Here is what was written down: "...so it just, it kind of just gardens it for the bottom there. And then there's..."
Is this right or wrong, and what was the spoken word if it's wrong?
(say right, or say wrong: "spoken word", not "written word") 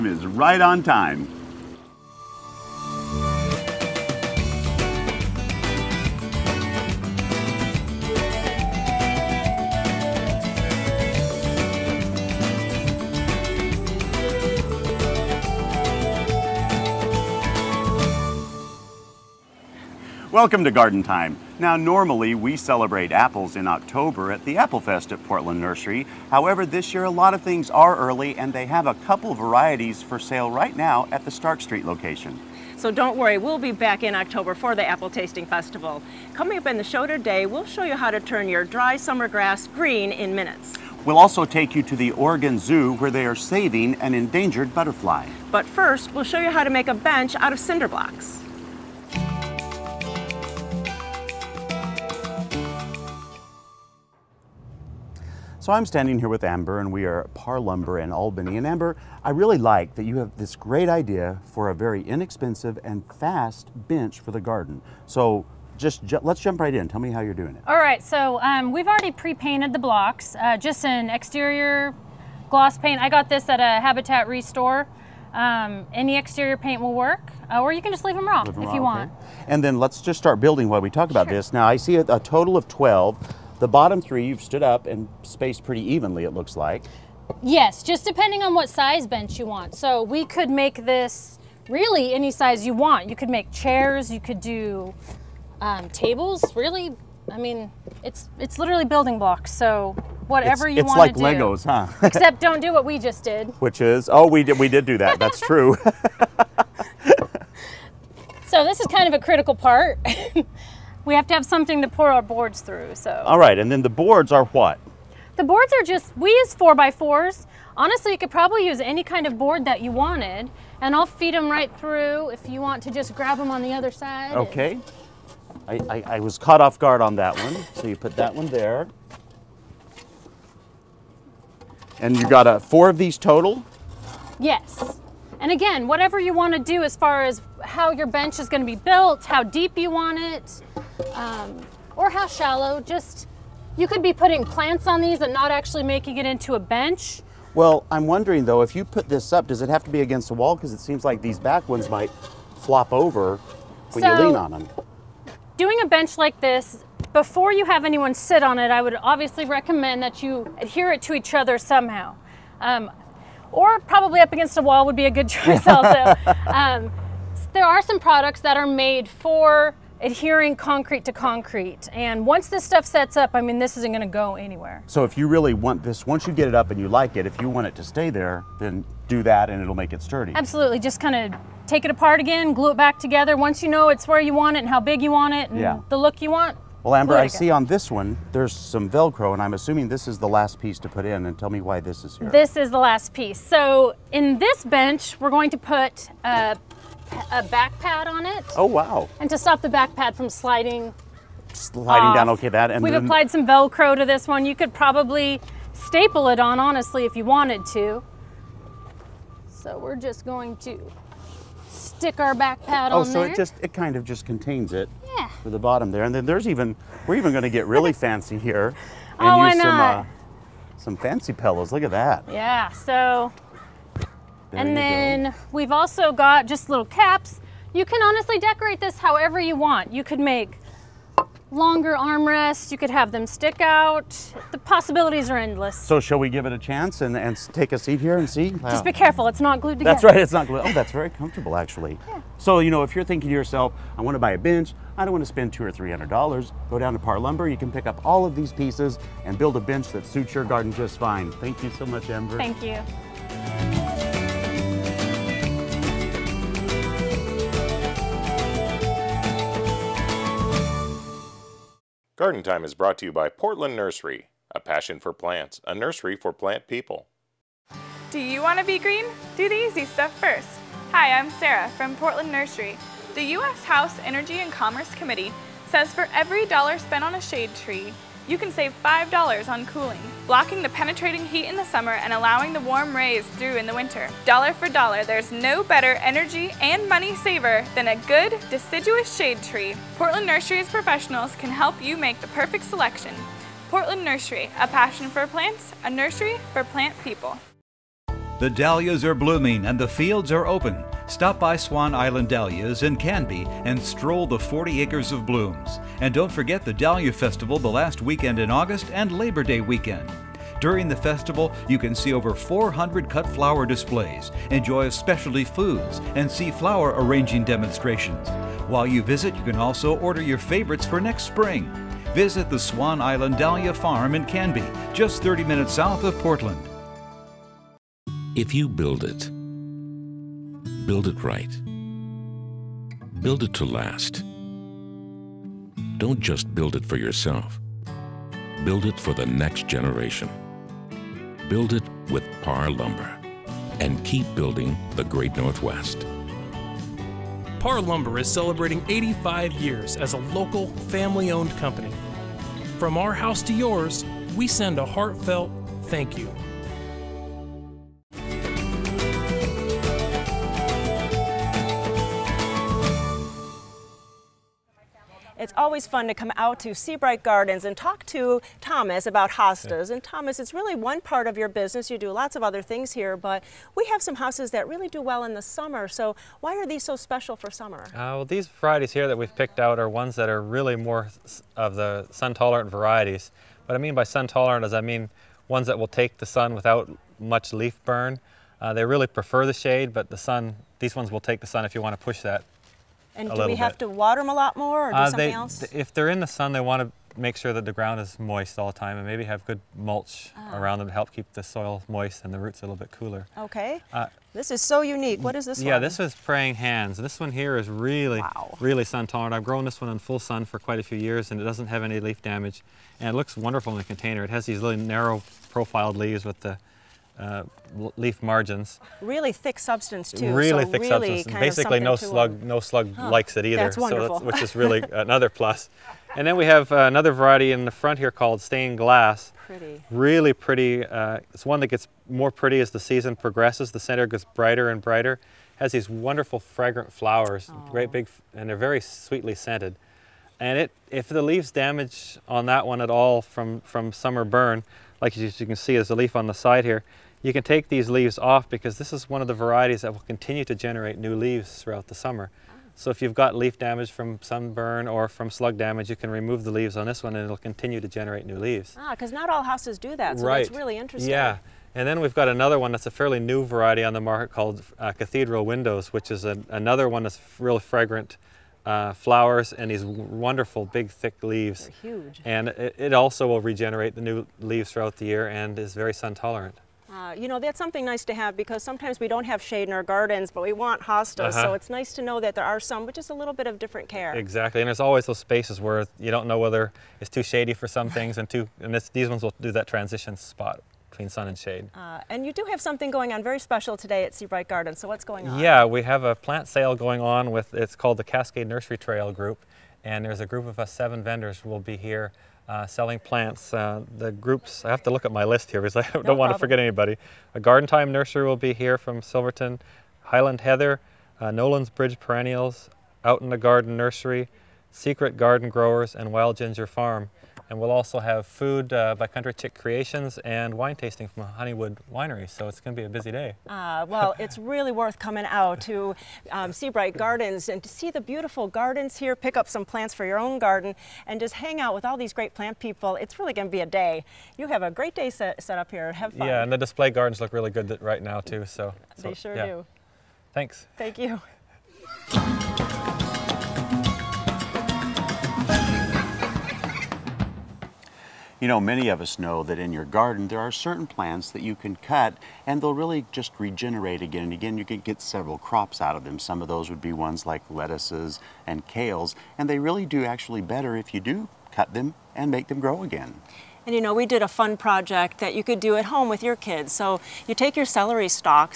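wrong: "contains", not "gardens".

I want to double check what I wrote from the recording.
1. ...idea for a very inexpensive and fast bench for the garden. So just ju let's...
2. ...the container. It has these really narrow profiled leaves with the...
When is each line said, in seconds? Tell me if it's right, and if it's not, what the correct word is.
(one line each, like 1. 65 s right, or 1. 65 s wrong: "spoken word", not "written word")
1. 60 s right
2. 413 s right.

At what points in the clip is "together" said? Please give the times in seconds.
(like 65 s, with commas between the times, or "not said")
182 s, 239 s.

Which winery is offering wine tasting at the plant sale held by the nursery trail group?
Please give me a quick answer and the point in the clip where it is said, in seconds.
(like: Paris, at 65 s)
Honeywood Winery, at 521 s.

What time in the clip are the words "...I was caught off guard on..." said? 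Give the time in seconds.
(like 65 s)
126 s.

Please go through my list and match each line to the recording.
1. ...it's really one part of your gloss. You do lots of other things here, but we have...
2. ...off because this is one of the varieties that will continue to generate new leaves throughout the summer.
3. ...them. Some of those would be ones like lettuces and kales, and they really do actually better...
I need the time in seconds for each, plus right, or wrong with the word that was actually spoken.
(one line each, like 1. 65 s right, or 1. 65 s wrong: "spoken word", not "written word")
1. 370 s wrong: "business", not "gloss"
2. 448 s right
3. 556 s right.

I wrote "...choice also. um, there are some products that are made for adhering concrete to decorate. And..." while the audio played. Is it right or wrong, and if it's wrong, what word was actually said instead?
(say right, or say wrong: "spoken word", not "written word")
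wrong: "concrete", not "decorate".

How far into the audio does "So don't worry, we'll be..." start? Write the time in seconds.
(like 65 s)
32 s.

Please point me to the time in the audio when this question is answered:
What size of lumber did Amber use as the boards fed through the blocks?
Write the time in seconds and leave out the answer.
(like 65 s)
116 s.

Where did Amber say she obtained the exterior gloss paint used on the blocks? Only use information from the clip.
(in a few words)
Habitat Restore.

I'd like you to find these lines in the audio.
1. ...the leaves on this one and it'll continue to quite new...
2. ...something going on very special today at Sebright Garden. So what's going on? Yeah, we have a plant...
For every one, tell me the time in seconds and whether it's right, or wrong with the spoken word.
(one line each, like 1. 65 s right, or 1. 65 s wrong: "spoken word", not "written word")
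1. 456 s wrong: "generate", not "quite"
2. 492 s right.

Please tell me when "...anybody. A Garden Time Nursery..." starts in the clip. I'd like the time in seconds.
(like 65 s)
506 s.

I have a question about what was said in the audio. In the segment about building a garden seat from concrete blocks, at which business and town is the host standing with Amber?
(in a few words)
Par Lumber in Albany.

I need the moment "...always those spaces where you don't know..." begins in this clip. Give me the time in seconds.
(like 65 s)
484 s.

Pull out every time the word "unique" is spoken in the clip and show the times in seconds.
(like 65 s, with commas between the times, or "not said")
404 s.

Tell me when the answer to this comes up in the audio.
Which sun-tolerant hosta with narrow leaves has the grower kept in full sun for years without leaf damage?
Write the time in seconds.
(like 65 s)
406 s.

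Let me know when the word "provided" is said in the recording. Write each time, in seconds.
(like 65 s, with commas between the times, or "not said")
not said.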